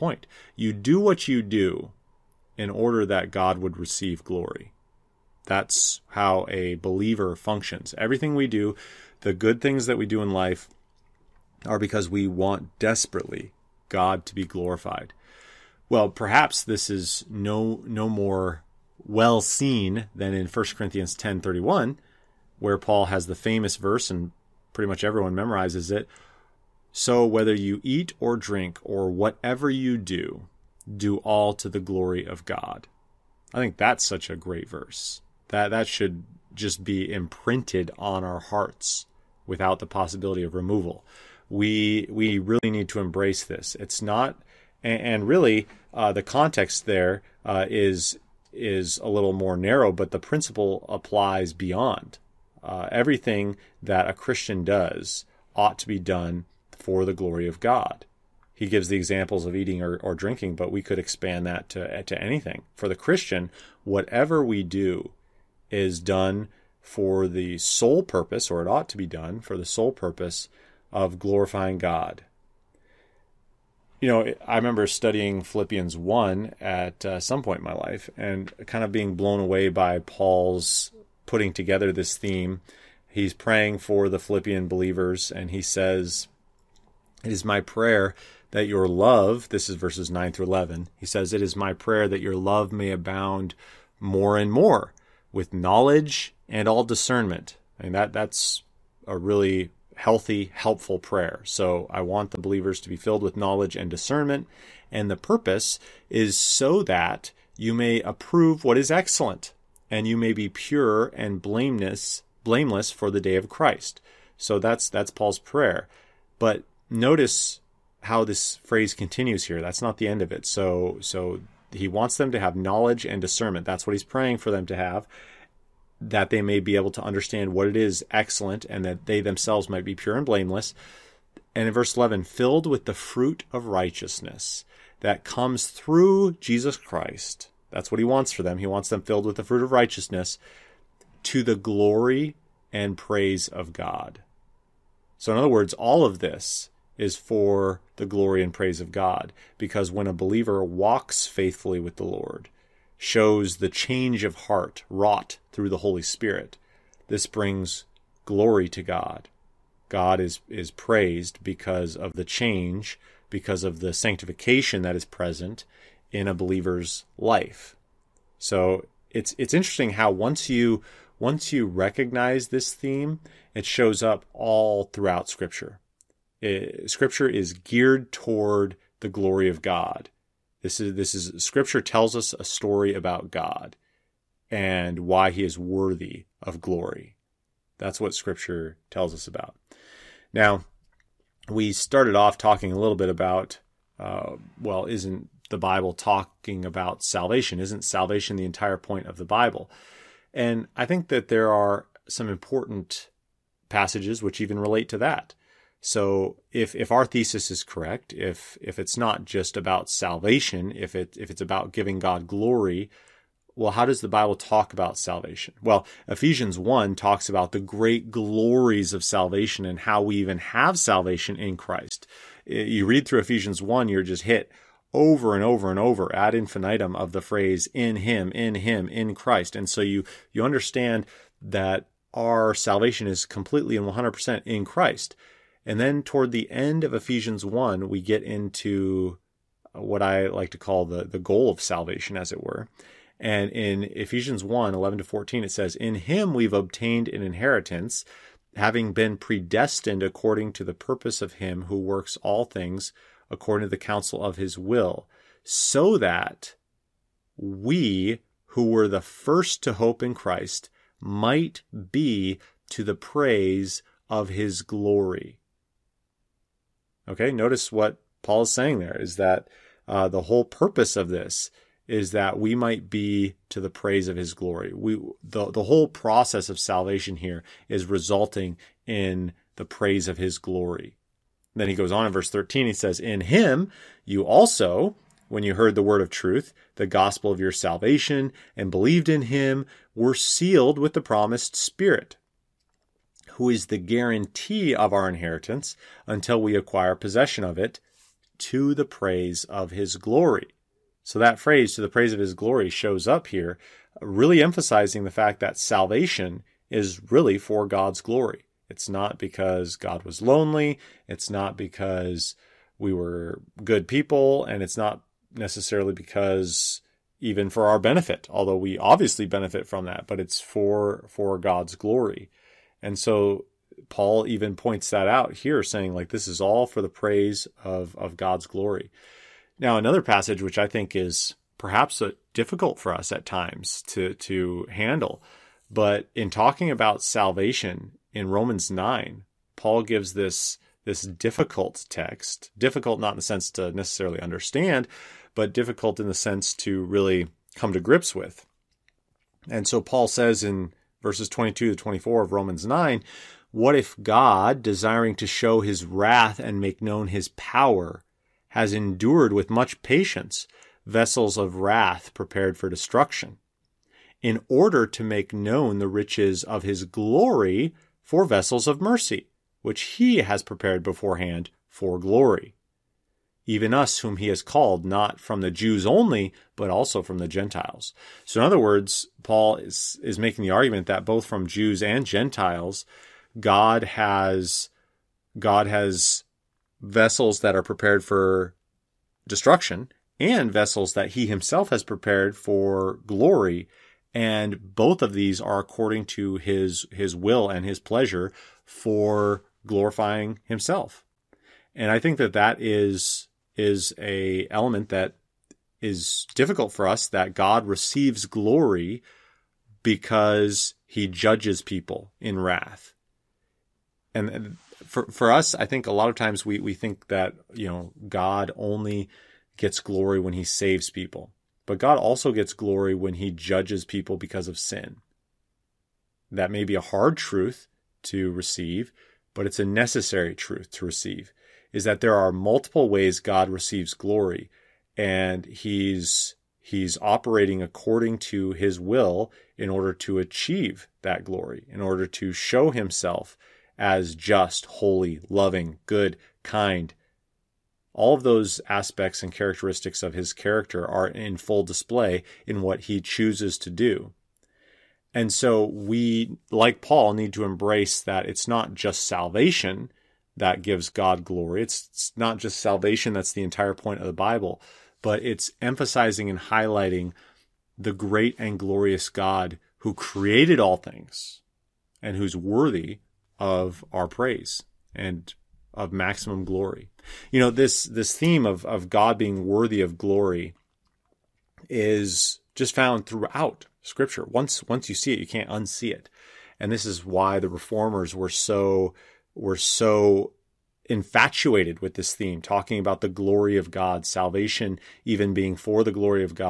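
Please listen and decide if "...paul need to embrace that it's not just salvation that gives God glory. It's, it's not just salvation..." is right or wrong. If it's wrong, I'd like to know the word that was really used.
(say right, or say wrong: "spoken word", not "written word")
right.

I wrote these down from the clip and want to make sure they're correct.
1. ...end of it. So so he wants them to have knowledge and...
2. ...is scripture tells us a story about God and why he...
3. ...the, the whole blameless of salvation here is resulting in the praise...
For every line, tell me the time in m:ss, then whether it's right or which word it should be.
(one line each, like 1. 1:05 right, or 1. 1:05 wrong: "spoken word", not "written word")
1. 2:00 right
2. 3:01 right
3. 4:35 wrong: "process", not "blameless".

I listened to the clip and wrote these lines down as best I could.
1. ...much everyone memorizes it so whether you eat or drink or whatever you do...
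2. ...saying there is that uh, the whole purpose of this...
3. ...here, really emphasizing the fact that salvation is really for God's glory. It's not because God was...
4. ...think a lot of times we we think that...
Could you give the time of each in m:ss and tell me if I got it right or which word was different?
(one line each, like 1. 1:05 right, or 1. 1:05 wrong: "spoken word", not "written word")
1. 0:24 right
2. 4:28 right
3. 5:03 right
4. 6:55 right.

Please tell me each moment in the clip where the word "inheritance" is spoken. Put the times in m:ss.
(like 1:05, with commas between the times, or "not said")
4:07, 4:55.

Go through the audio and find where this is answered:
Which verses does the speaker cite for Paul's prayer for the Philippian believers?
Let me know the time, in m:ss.
1:29.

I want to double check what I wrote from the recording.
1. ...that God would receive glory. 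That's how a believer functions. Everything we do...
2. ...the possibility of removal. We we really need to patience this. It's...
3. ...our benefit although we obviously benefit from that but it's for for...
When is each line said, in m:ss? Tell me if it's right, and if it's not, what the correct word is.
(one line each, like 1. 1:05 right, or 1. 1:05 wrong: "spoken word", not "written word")
1. 0:03 right
2. 0:39 wrong: "embrace", not "patience"
3. 5:17 right.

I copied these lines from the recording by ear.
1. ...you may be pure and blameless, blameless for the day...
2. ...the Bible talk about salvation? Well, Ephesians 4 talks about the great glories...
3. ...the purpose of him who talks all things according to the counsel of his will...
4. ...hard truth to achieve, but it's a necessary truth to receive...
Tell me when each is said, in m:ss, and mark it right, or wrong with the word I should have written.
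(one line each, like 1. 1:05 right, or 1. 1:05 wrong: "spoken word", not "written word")
1. 1:50 right
2. 3:34 wrong: "1", not "4"
3. 4:10 wrong: "works", not "talks"
4. 7:06 wrong: "receive", not "achieve".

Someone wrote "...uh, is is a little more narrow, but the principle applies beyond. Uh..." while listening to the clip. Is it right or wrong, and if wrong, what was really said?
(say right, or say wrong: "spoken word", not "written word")
right.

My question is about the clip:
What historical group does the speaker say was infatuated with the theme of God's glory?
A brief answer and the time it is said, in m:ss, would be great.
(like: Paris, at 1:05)
The reformers, at 8:07.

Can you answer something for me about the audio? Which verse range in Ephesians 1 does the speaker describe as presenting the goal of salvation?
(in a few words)
11 to 14.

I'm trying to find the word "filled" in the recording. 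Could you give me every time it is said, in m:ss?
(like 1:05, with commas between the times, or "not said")
1:42, 2:12, 2:19.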